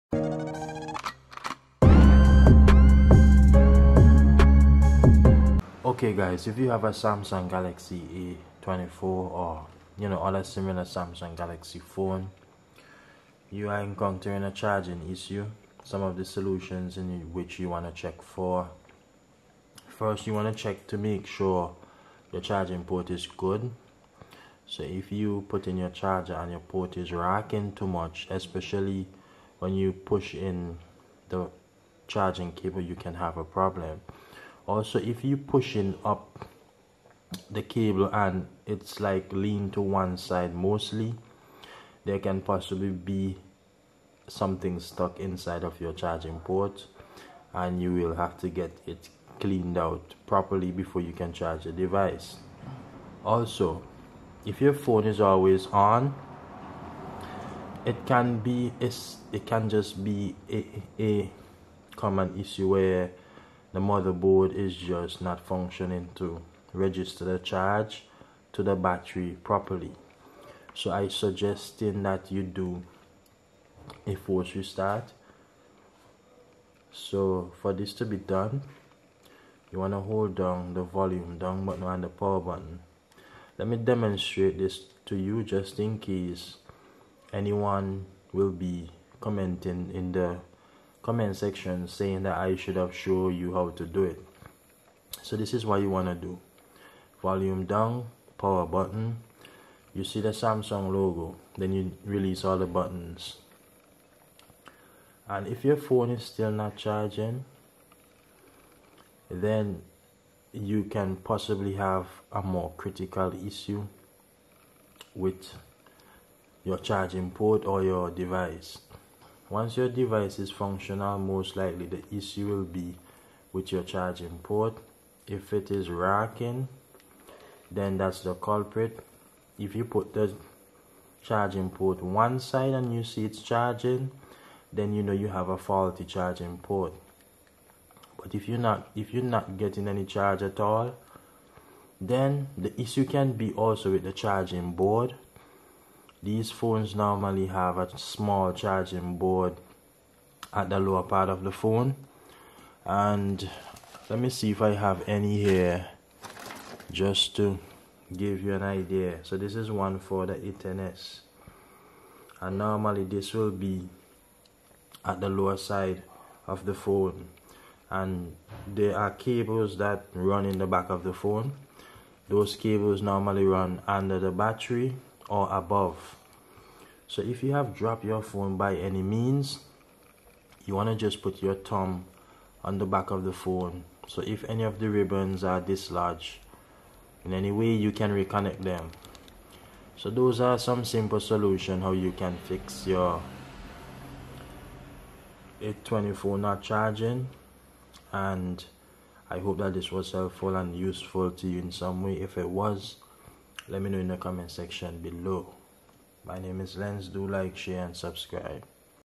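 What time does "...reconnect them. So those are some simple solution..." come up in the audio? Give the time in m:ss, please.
3:08.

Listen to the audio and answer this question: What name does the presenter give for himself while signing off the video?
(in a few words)
Lenz.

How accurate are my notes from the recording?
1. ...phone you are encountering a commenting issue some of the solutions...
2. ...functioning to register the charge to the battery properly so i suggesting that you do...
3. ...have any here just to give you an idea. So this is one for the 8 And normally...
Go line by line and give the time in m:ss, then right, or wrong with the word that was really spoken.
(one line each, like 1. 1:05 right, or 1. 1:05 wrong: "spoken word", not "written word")
1. 0:11 wrong: "charging", not "commenting"
2. 1:05 right
3. 2:34 right.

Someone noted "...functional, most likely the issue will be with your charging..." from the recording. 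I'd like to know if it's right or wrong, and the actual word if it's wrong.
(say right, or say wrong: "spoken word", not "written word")
right.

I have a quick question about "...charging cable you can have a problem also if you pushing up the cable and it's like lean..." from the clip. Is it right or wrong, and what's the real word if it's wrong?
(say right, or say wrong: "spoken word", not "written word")
right.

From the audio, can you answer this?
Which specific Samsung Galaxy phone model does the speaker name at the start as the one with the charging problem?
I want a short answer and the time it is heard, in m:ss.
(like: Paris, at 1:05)
Galaxy A24, at 0:06.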